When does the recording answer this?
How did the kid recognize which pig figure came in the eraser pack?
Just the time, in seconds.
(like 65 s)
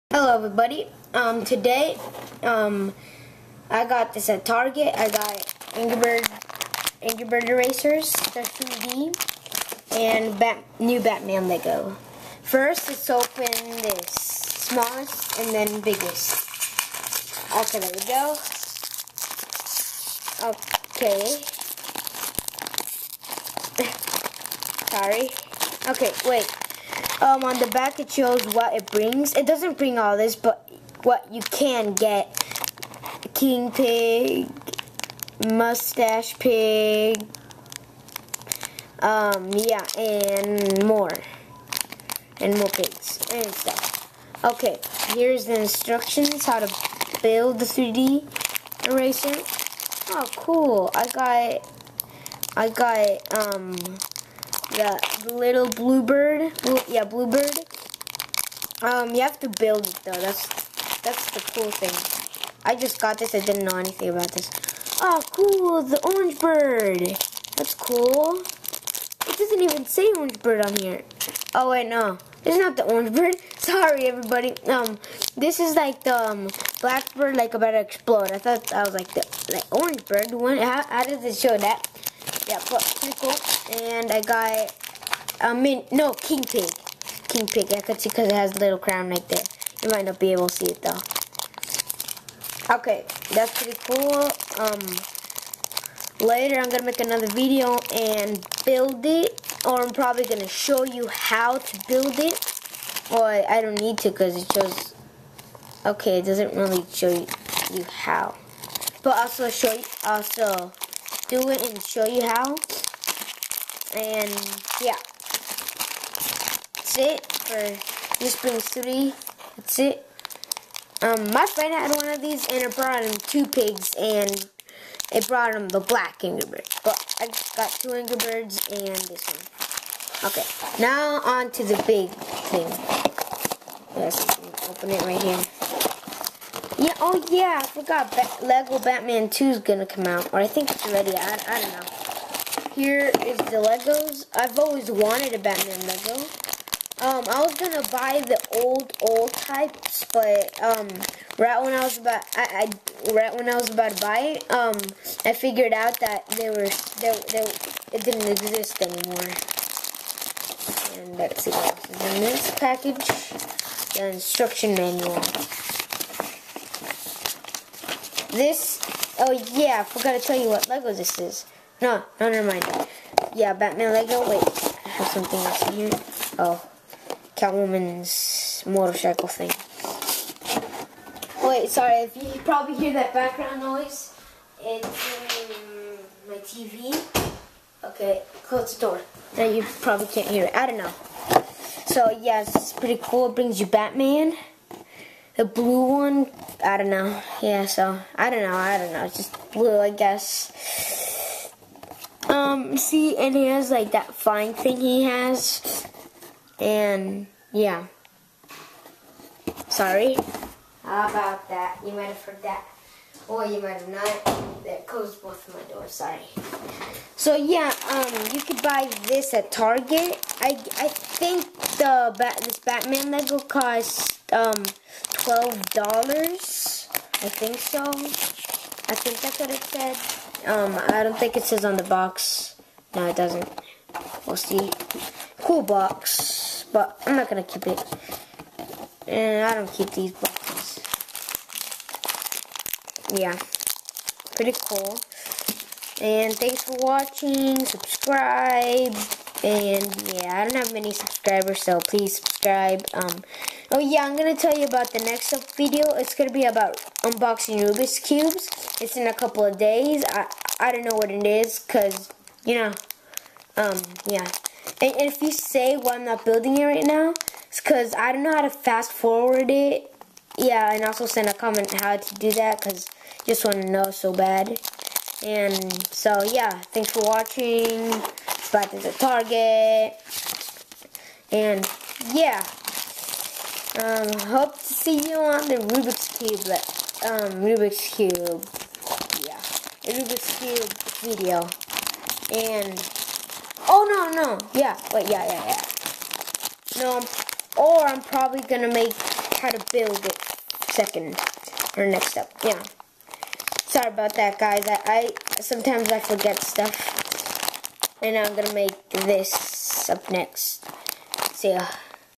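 88 s.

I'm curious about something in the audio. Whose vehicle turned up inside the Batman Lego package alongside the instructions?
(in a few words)
Catwoman's motorcycle.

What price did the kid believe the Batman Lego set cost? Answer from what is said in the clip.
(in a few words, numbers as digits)
$12.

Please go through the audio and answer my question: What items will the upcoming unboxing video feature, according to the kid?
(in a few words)
Rubik's Cubes.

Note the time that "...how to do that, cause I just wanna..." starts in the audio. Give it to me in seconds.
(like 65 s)
271 s.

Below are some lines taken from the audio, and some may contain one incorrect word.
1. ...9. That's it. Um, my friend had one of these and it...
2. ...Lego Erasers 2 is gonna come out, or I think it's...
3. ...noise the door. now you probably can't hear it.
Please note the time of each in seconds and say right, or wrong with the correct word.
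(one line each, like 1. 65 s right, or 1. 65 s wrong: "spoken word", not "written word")
1. 118 s wrong: "3", not "9"
2. 138 s wrong: "Batman", not "Erasers"
3. 188 s wrong: "close", not "noise".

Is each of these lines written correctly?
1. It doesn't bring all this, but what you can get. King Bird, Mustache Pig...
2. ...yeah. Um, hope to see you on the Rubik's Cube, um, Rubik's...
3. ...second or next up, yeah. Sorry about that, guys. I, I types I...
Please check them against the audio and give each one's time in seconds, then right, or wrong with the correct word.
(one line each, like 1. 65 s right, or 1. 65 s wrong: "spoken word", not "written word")
1. 29 s wrong: "Pig", not "Bird"
2. 282 s right
3. 300 s wrong: "sometimes", not "types".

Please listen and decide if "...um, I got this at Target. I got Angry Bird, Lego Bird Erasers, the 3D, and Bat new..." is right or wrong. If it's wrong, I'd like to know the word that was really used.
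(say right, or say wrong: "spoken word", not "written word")
wrong: "Angry", not "Lego".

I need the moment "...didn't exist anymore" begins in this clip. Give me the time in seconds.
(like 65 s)
158 s.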